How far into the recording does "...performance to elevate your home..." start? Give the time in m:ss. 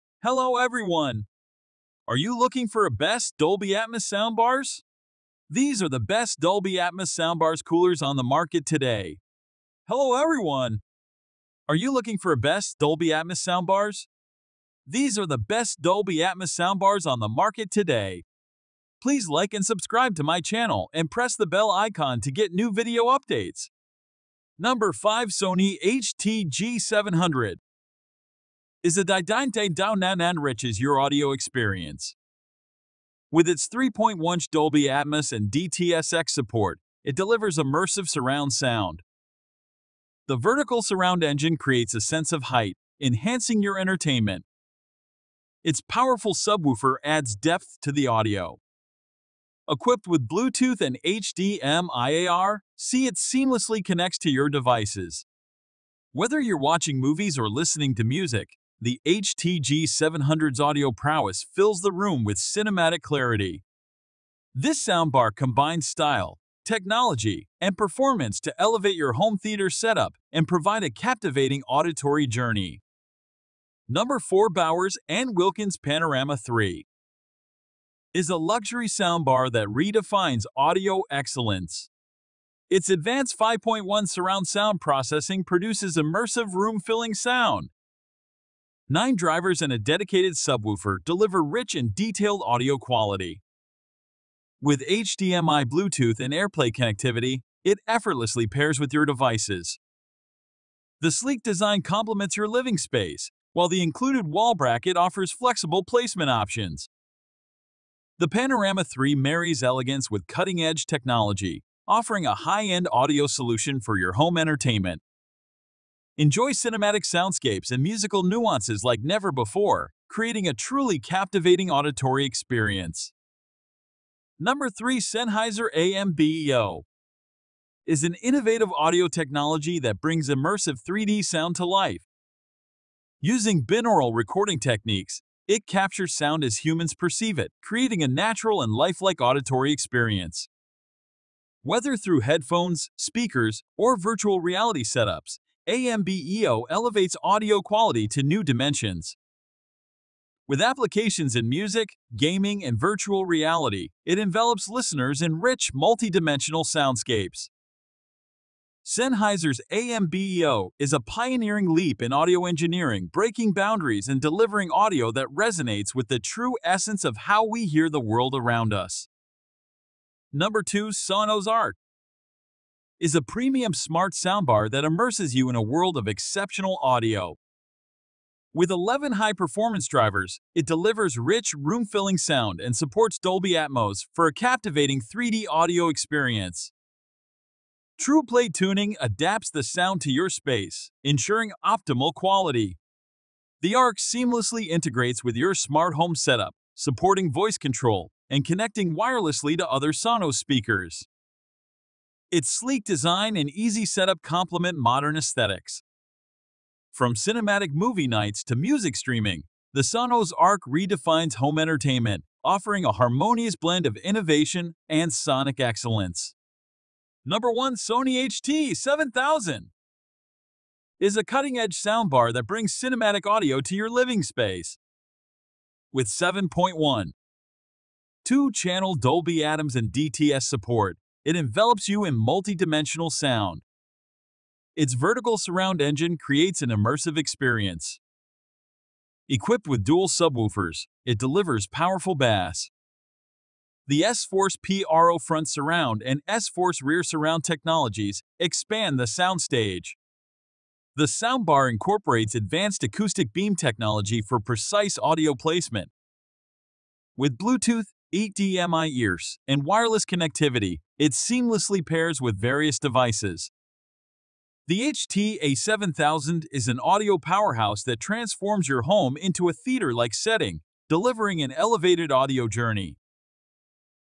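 1:07.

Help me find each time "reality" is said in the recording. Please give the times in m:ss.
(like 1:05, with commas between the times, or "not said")
2:24, 2:33.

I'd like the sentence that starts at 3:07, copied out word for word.
TruePlay Tuning adapts the sound to your space, ensuring optimal quality.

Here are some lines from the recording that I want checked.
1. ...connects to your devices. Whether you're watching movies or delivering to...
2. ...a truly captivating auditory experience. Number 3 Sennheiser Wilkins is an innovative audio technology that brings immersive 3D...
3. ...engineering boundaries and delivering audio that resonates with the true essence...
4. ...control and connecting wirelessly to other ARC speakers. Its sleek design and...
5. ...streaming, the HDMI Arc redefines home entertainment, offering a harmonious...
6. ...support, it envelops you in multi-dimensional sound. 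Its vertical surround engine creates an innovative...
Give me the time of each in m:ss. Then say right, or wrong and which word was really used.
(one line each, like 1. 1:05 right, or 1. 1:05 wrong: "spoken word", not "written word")
1. 0:53 wrong: "listening", not "delivering"
2. 2:00 wrong: "AMBEO", not "Wilkins"
3. 2:43 wrong: "breaking", not "engineering"
4. 3:17 wrong: "Sonos", not "ARC"
5. 3:28 wrong: "Sonos", not "HDMI"
6. 3:50 wrong: "immersive", not "innovative".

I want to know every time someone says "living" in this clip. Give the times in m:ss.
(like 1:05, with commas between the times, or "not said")
1:42, 3:43.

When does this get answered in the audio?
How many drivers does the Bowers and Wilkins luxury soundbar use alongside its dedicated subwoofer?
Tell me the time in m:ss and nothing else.
1:28.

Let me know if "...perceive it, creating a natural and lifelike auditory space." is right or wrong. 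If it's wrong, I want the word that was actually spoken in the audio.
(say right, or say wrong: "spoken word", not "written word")
wrong: "experience", not "space".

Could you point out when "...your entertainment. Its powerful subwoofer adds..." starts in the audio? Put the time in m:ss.
0:43.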